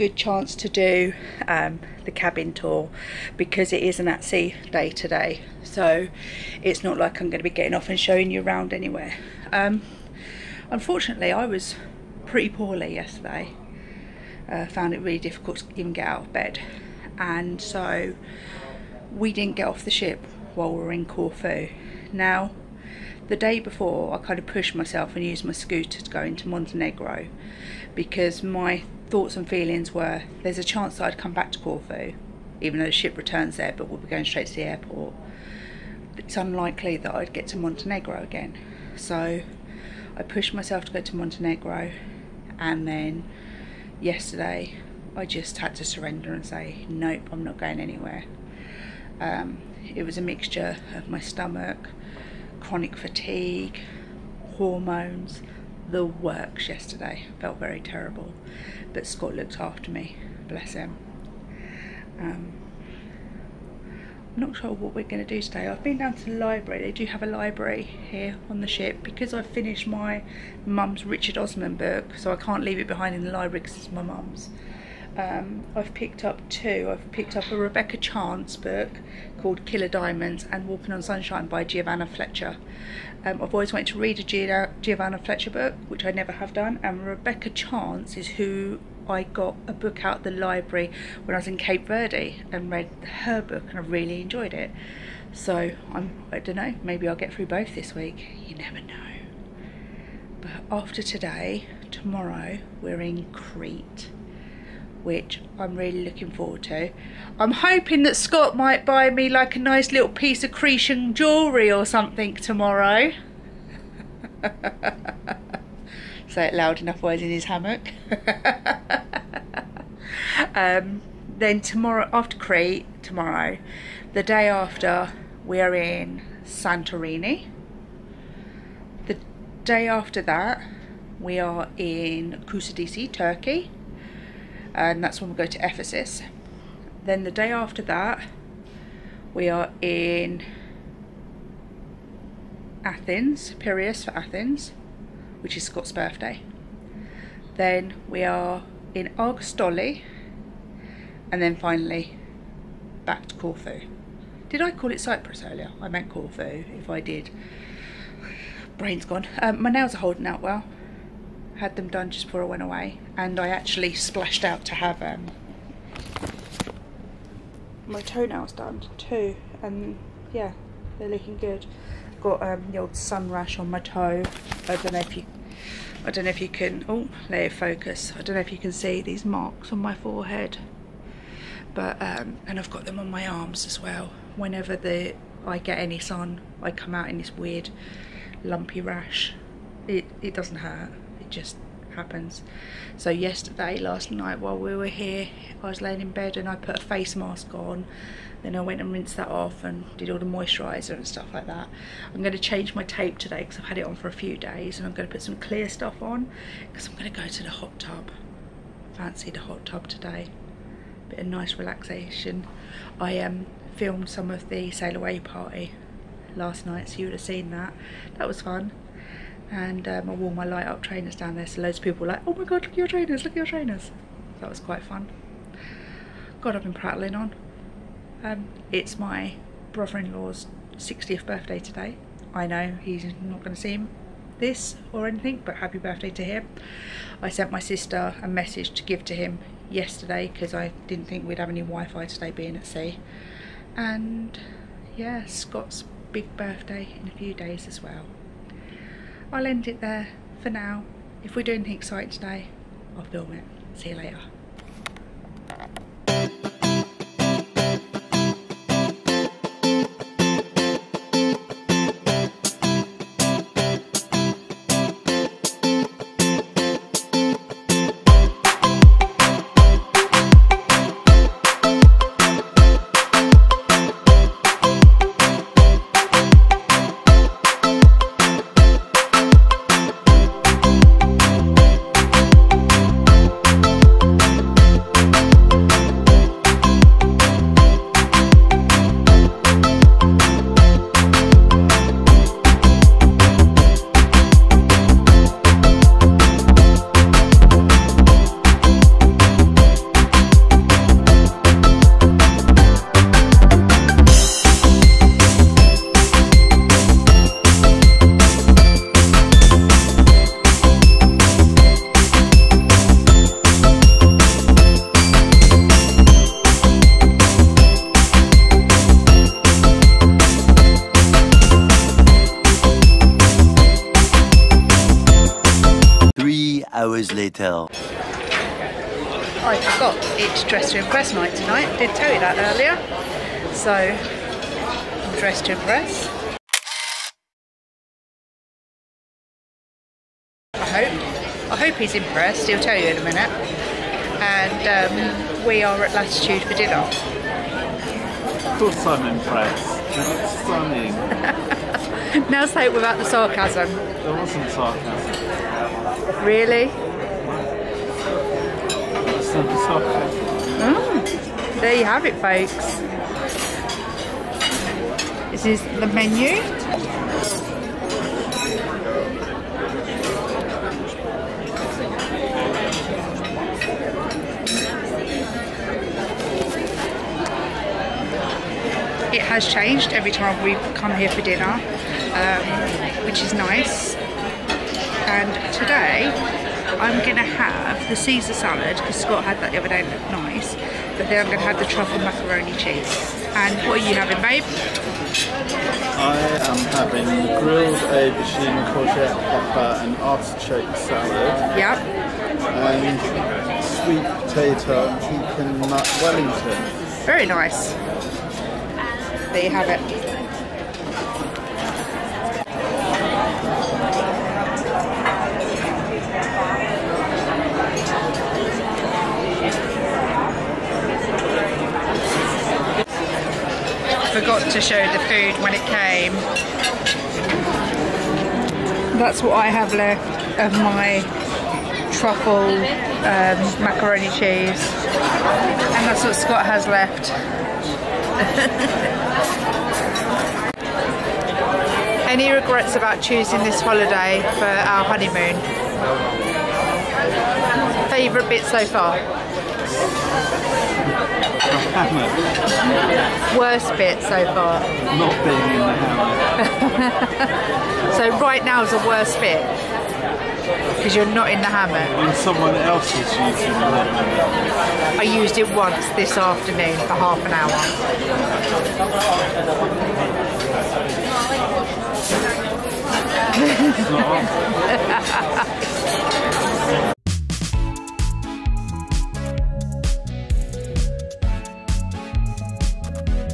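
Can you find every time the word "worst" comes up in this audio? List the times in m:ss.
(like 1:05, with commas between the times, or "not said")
7:33, 7:38.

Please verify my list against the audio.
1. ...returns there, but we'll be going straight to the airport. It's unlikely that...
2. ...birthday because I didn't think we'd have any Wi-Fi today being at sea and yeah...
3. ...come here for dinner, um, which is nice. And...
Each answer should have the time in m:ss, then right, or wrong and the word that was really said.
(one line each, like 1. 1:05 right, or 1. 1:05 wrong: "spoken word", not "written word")
1. 0:33 right
2. 3:59 wrong: "yesterday", not "birthday"
3. 6:20 right.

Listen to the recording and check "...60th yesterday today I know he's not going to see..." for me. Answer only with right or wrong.
wrong.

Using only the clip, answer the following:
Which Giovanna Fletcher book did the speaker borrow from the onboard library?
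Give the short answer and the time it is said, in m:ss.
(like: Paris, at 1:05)
Walking on Sunshine, at 1:20.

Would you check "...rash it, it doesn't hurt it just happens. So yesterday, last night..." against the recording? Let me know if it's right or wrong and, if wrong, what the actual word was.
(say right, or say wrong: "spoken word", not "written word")
right.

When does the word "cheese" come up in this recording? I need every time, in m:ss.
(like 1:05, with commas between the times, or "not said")
6:32, 7:14.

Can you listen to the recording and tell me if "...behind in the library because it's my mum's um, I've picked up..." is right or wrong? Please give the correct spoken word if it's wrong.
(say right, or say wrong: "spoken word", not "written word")
right.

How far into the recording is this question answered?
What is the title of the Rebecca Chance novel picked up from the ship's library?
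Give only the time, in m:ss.
1:19.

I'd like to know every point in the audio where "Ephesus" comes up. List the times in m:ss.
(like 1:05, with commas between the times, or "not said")
2:15.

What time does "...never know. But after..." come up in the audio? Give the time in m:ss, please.
1:38.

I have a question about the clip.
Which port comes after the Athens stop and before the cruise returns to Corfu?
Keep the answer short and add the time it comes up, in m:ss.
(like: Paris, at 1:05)
Argostoli, at 2:29.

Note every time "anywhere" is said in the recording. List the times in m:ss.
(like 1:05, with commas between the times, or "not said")
0:08, 0:47.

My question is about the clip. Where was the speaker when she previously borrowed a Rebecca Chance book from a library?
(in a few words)
Cape Verde.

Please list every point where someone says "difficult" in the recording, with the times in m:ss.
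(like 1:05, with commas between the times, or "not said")
0:15.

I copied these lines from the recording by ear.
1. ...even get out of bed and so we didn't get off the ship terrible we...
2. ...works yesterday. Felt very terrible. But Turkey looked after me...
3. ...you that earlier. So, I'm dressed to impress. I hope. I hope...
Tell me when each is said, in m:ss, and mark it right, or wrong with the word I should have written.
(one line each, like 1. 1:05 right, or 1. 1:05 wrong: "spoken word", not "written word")
1. 0:15 wrong: "while", not "terrible"
2. 0:56 wrong: "Scott", not "Turkey"
3. 5:32 right.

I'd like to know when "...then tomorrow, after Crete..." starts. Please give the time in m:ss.
2:01.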